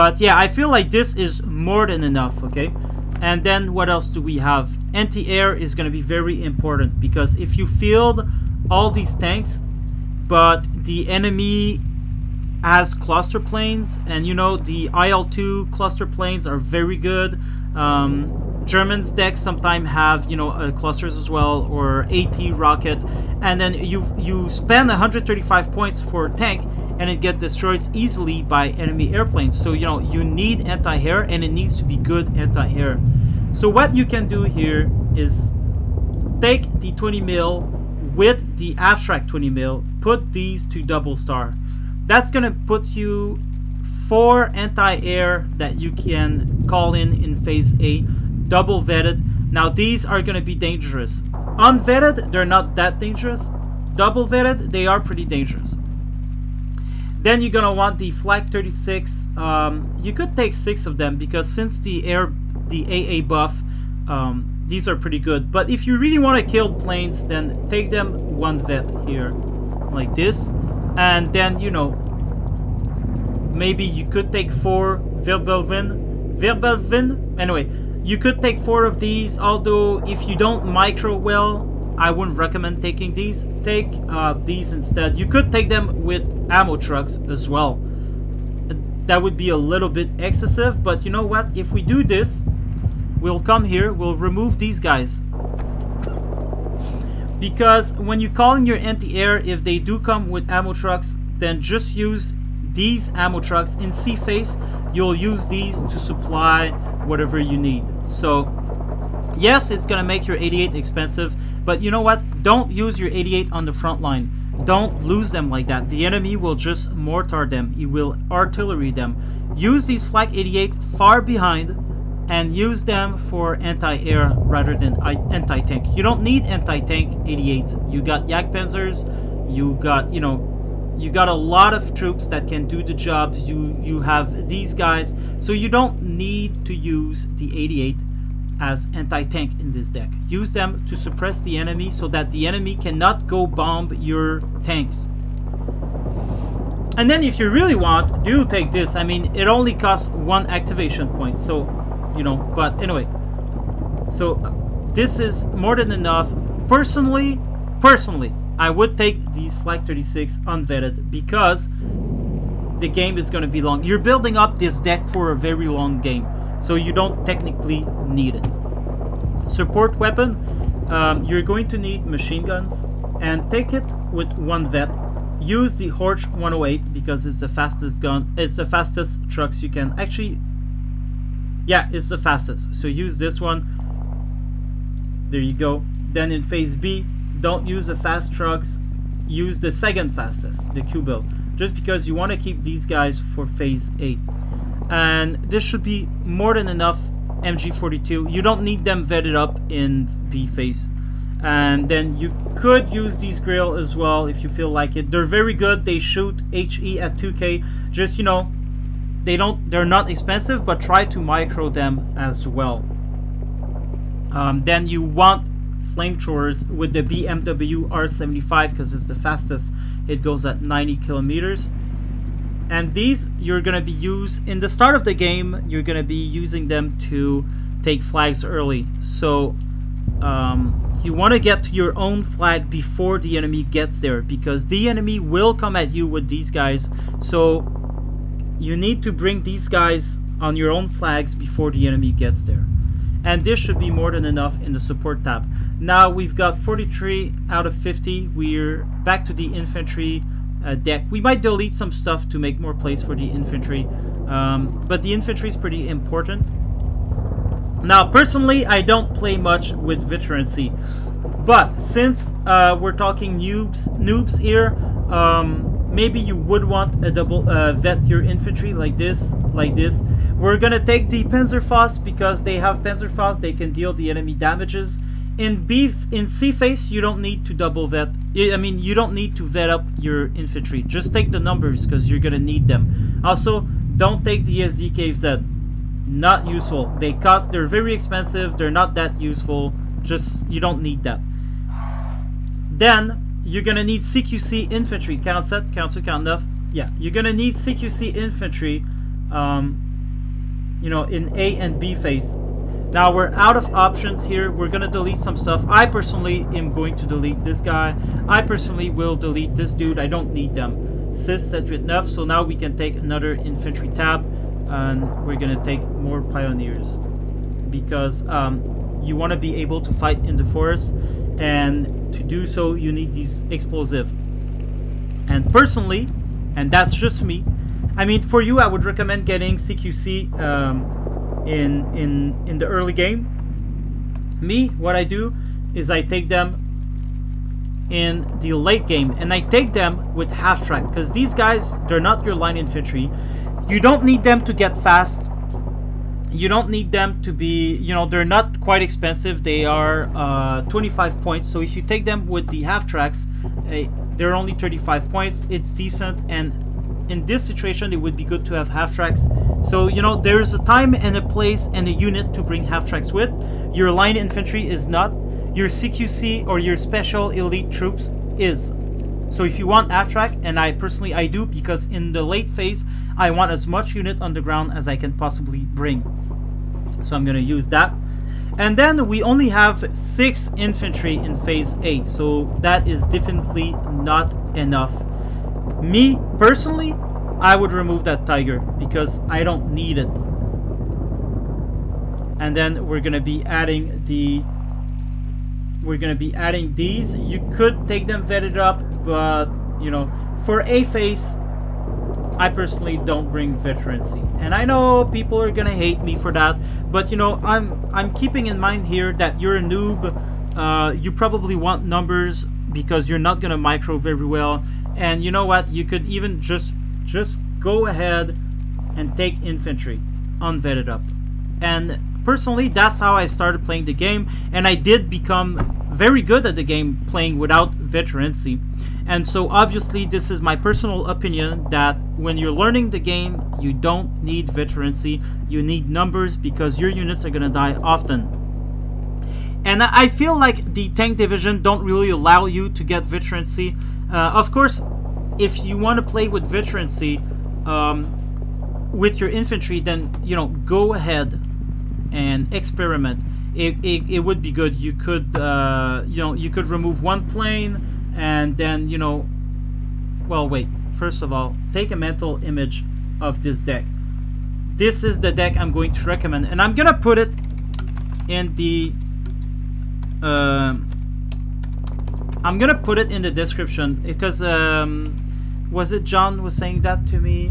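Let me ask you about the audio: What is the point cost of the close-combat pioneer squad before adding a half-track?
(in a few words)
25.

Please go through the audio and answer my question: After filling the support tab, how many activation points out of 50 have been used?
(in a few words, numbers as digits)
43.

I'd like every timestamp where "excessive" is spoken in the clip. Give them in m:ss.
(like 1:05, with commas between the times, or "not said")
1:30.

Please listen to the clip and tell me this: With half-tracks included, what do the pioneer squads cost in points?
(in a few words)
35.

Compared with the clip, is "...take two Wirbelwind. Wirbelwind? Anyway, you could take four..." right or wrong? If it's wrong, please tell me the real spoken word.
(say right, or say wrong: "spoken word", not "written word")
wrong: "four", not "two".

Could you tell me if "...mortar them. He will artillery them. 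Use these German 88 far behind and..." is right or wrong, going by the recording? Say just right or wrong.
wrong.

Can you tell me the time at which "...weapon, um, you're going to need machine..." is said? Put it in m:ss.
2:49.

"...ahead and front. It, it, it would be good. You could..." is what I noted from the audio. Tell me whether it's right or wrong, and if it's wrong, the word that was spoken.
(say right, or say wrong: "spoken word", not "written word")
wrong: "experiment", not "front".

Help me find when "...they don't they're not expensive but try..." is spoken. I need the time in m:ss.
3:29.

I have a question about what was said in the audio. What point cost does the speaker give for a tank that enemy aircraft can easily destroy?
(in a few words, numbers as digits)
135.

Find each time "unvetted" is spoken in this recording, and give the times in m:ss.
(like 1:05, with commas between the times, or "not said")
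0:51, 2:40, 7:00.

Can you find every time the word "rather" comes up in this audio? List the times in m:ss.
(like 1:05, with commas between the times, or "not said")
2:04.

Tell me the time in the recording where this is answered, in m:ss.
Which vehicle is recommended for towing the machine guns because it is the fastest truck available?
2:55.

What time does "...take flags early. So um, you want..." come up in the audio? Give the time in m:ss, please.
3:47.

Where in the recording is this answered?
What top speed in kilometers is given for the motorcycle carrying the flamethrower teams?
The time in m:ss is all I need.
3:40.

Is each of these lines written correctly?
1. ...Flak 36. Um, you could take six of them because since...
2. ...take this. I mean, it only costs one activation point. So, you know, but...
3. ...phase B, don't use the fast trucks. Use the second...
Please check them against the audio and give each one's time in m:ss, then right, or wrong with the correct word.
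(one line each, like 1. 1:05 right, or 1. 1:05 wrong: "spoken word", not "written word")
1. 0:58 right
2. 2:28 right
3. 3:06 right.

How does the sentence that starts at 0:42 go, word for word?
That's gonna put you four anti-air that you can call in in phase A, double vetted.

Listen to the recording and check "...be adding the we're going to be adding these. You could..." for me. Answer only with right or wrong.
right.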